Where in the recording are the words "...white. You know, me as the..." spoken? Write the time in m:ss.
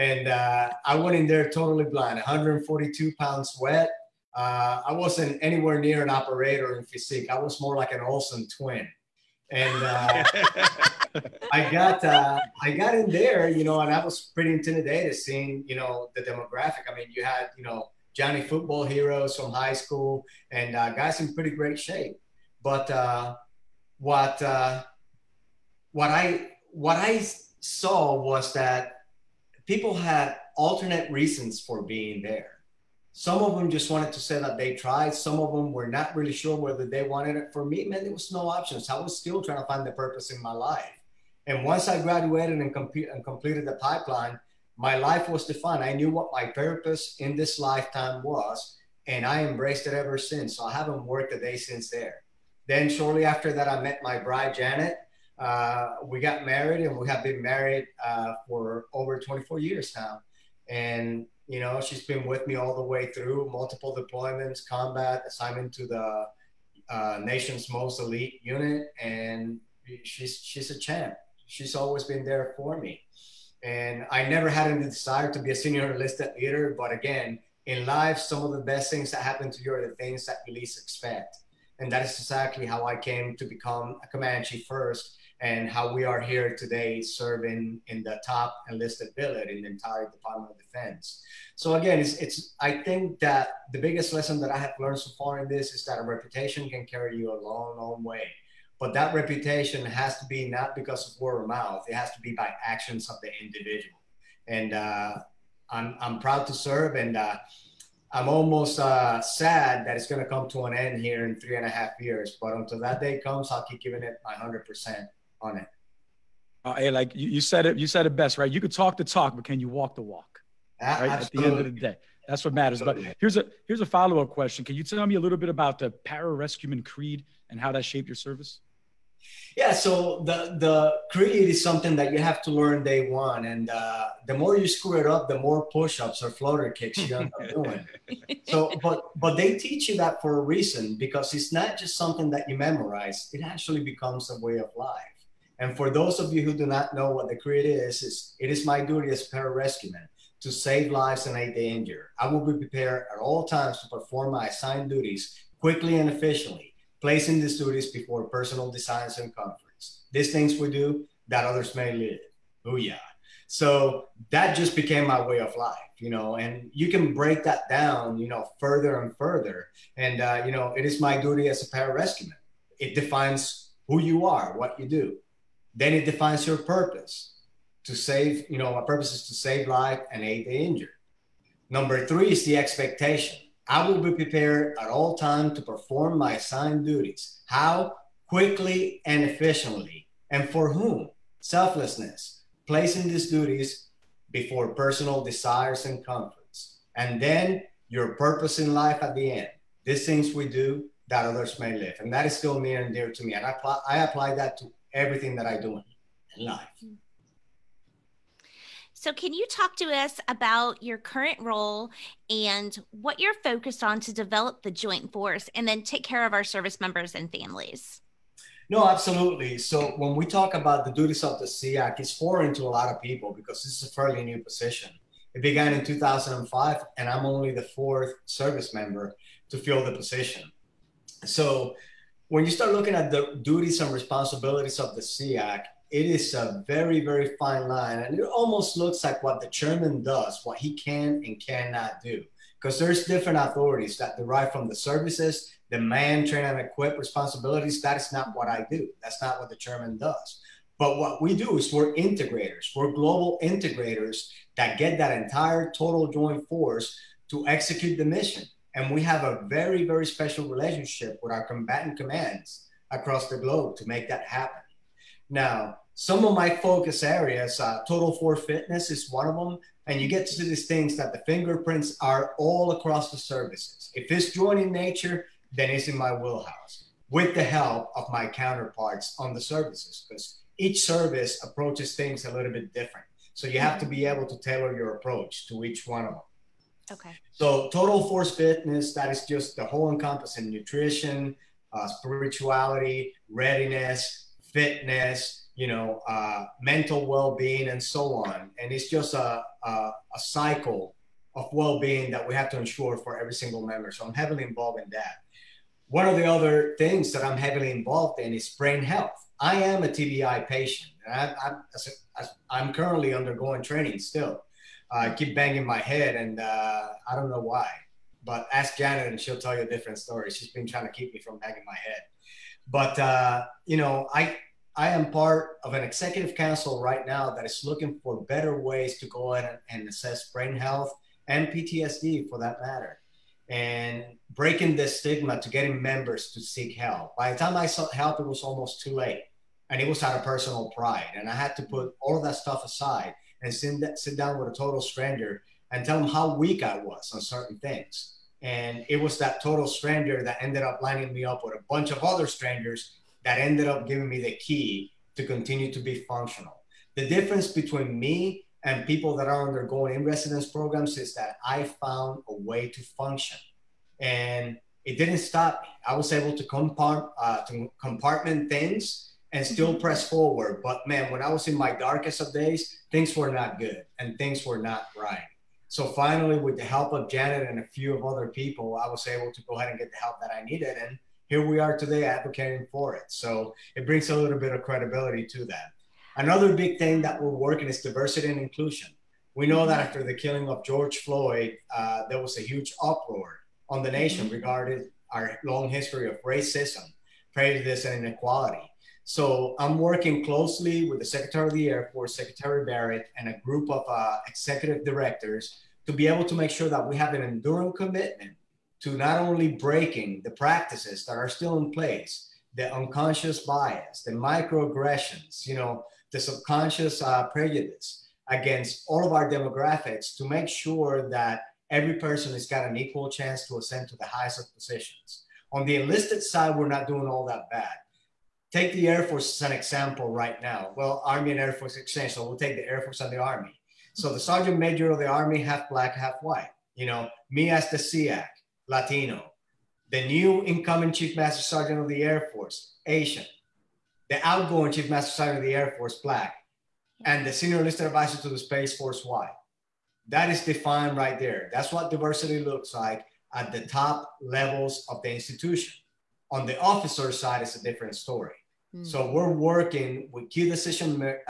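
7:16.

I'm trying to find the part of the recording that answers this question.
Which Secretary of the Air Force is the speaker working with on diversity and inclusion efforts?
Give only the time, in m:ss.
6:42.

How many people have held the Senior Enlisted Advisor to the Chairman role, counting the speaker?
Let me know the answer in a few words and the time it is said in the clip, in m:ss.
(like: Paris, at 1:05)
4, at 3:47.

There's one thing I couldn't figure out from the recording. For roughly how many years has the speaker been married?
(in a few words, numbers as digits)
24 years.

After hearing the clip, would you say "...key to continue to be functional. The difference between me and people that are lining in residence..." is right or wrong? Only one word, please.
wrong.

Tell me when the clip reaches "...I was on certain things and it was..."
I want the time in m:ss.
5:46.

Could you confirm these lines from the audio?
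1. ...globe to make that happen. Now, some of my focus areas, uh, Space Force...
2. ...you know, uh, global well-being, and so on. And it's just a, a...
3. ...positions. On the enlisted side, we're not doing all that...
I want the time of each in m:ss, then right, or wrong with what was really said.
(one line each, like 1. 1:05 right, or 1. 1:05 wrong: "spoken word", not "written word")
1. 4:23 wrong: "Total", not "Space"
2. 4:55 wrong: "mental", not "global"
3. 7:04 right.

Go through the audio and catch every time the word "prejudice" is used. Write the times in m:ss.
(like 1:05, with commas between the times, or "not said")
6:37, 6:57.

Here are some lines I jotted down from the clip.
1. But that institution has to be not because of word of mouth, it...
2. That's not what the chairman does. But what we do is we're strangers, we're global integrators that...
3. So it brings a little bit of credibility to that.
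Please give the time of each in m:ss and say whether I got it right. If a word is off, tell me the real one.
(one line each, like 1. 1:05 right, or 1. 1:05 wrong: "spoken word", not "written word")
1. 1:38 wrong: "reputation", not "institution"
2. 4:09 wrong: "integrators", not "strangers"
3. 6:23 right.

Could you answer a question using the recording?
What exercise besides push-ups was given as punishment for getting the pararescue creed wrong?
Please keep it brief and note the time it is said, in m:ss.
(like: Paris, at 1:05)
floater kicks, at 2:16.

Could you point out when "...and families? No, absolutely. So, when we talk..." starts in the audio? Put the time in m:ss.
3:37.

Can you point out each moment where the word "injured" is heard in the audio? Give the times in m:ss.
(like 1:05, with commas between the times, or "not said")
2:31, 3:00.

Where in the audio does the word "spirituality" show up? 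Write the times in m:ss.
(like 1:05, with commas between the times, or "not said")
4:51.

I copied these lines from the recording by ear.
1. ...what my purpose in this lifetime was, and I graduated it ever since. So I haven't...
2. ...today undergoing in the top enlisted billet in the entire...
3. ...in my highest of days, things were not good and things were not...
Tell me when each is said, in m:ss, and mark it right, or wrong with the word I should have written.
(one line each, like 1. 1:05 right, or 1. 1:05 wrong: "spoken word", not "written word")
1. 0:46 wrong: "embraced", not "graduated"
2. 1:26 wrong: "serving", not "undergoing"
3. 6:11 wrong: "darkest", not "highest".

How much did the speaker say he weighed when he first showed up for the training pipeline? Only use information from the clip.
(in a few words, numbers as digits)
142 pounds.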